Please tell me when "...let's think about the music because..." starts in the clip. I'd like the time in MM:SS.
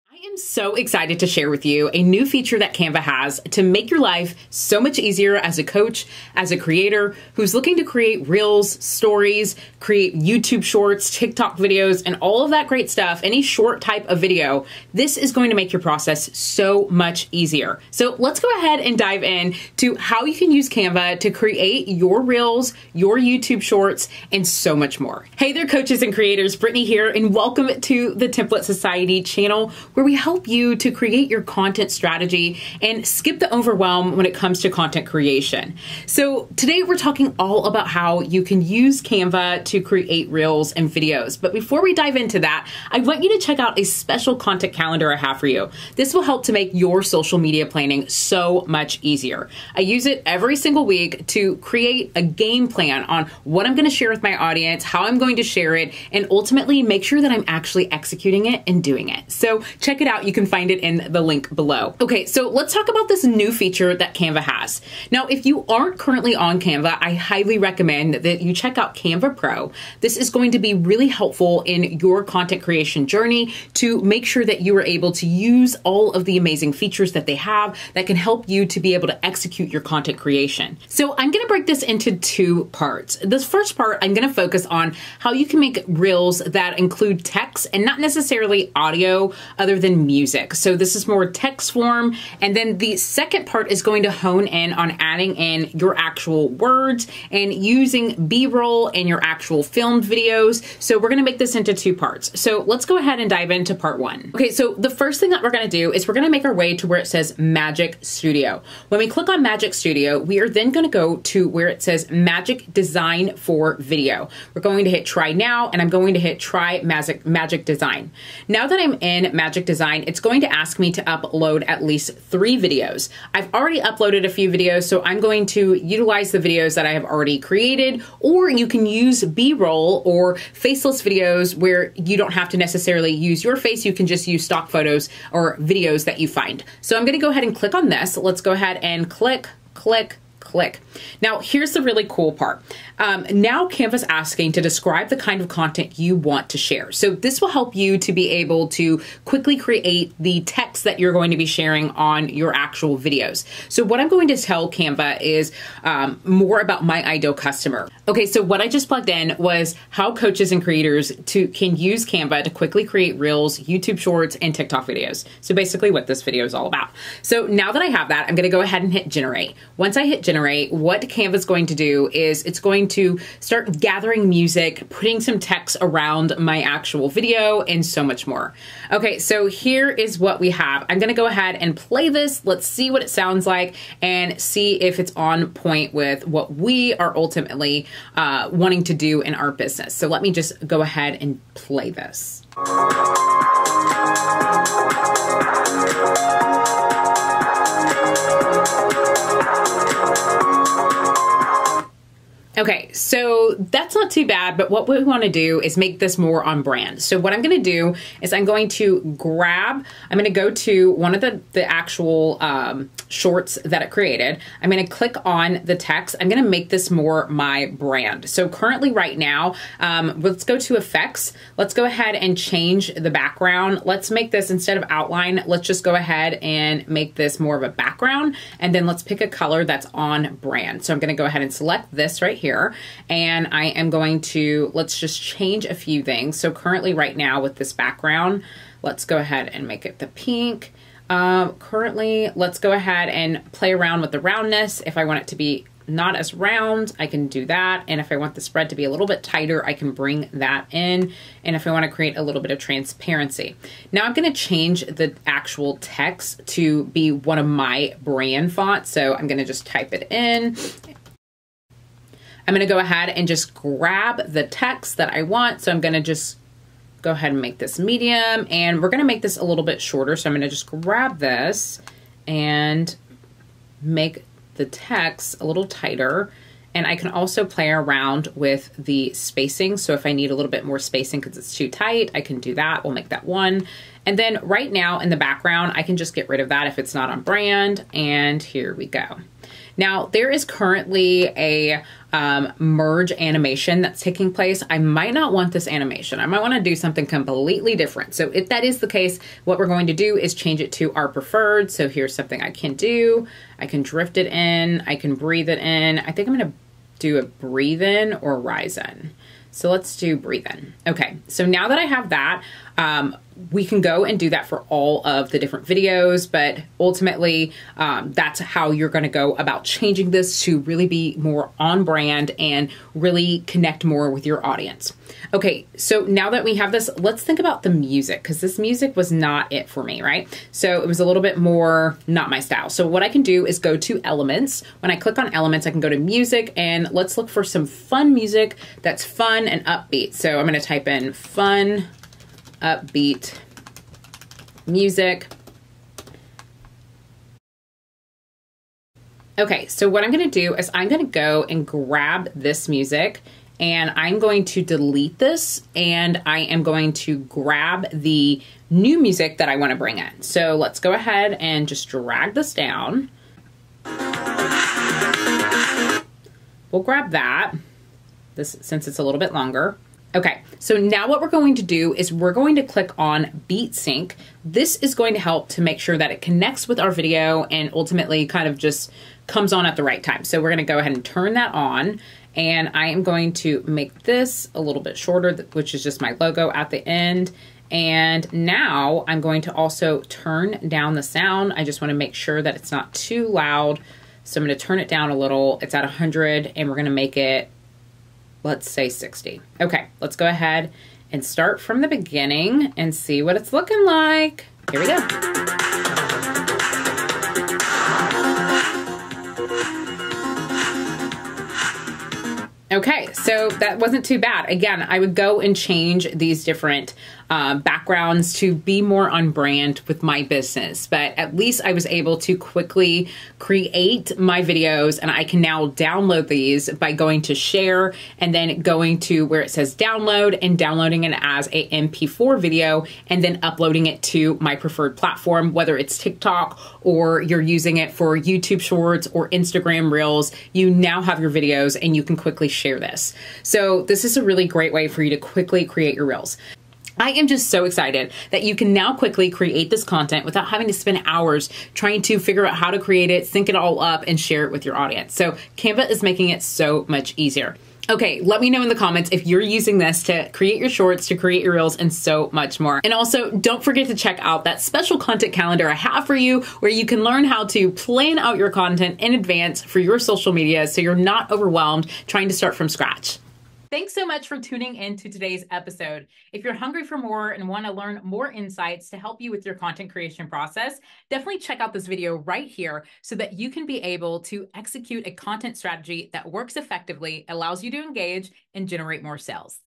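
05:26.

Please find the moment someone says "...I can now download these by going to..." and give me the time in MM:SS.
07:05.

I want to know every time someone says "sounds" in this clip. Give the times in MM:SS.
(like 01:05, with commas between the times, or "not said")
03:03, 06:31.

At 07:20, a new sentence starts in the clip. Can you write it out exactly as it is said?
You now have your videos and you can quickly share this.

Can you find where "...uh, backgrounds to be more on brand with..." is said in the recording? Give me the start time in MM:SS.
06:57.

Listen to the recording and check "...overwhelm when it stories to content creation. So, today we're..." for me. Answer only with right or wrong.
wrong.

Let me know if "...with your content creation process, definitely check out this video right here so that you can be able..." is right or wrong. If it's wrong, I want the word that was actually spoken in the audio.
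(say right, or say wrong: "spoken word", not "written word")
right.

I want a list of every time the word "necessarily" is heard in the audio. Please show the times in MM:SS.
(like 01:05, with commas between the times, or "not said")
01:27, 02:12.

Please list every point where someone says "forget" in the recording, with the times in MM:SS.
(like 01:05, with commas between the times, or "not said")
07:43.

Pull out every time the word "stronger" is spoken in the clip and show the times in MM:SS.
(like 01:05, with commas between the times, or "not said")
not said.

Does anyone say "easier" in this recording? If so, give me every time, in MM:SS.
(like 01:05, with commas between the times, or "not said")
00:04, 00:17, 00:49, 07:37.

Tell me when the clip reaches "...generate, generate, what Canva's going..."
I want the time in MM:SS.
02:50.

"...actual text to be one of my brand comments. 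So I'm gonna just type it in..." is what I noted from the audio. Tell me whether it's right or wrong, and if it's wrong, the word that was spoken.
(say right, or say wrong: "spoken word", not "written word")
wrong: "fonts", not "comments".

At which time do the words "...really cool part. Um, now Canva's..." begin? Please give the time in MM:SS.
02:21.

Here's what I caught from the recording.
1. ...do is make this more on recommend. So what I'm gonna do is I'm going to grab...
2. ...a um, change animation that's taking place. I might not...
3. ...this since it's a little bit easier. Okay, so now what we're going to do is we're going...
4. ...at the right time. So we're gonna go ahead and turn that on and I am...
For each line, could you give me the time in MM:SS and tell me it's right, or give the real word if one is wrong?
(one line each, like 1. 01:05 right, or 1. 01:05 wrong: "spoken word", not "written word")
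1. 03:25 wrong: "brand", not "recommend"
2. 04:51 wrong: "merge", not "change"
3. 06:08 wrong: "longer", not "easier"
4. 06:19 right.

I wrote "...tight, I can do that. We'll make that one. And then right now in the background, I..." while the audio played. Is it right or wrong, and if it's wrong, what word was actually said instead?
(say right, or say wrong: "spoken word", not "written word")
right.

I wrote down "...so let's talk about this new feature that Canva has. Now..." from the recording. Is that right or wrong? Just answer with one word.
right.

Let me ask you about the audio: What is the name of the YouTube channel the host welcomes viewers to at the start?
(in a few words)
Template Society.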